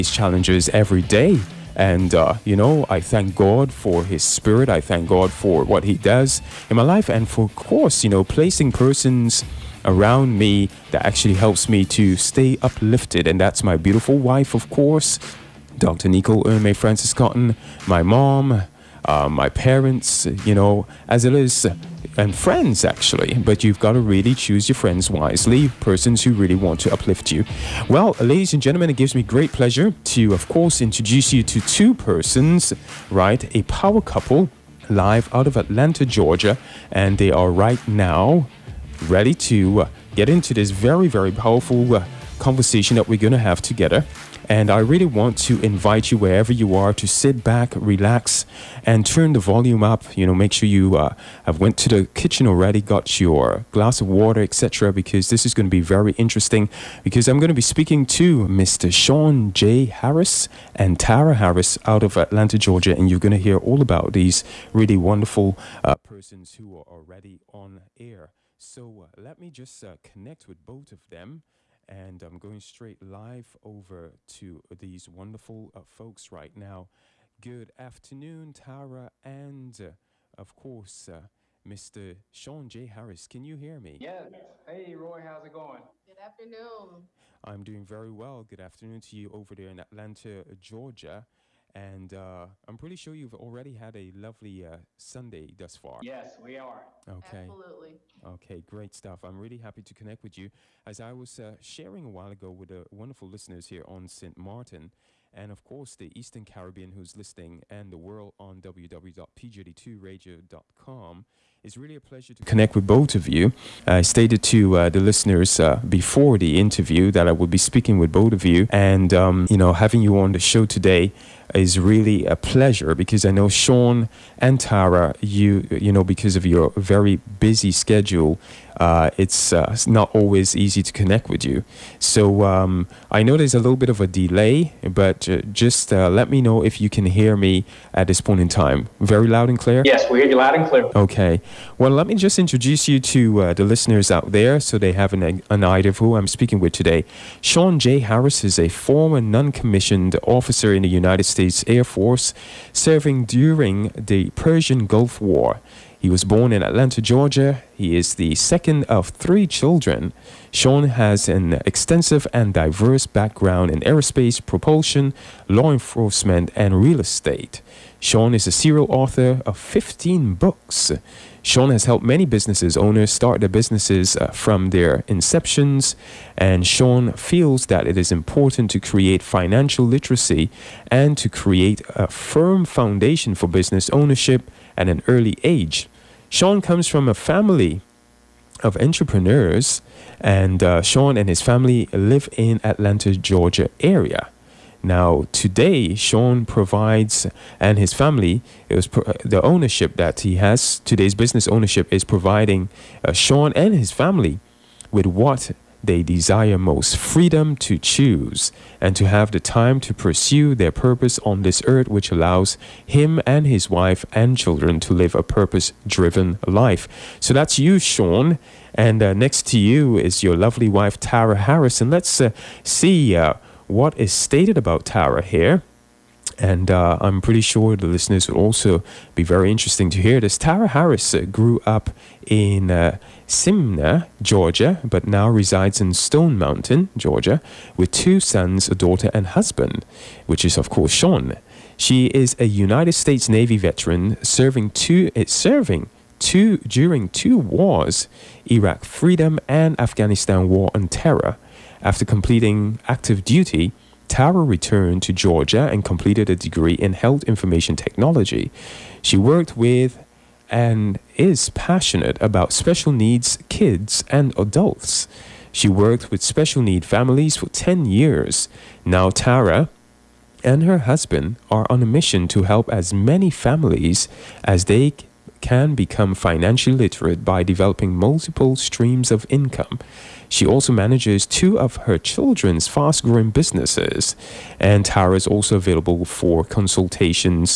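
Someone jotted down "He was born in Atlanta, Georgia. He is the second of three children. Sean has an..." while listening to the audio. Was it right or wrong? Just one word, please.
right.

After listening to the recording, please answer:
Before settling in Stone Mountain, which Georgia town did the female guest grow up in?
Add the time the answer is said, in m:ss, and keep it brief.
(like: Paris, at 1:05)
Smyrna, at 3:53.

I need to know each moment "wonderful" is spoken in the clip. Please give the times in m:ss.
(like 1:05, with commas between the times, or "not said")
1:04, 1:15, 1:42.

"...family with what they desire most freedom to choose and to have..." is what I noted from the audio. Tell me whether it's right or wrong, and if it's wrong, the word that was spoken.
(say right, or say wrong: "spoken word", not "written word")
right.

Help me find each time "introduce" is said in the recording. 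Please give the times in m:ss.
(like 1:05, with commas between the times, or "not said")
0:30, 2:22.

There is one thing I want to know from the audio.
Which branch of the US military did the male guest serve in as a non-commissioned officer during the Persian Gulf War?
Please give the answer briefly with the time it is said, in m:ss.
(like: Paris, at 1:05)
United States Air Force, at 2:30.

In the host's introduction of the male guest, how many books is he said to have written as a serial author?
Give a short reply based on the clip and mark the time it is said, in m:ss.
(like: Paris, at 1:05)
15, at 2:49.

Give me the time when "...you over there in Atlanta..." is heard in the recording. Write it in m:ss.
1:29.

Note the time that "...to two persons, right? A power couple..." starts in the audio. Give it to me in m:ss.
0:31.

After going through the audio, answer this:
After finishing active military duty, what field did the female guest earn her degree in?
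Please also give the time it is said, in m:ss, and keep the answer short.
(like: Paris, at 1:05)
Health information technology, at 4:16.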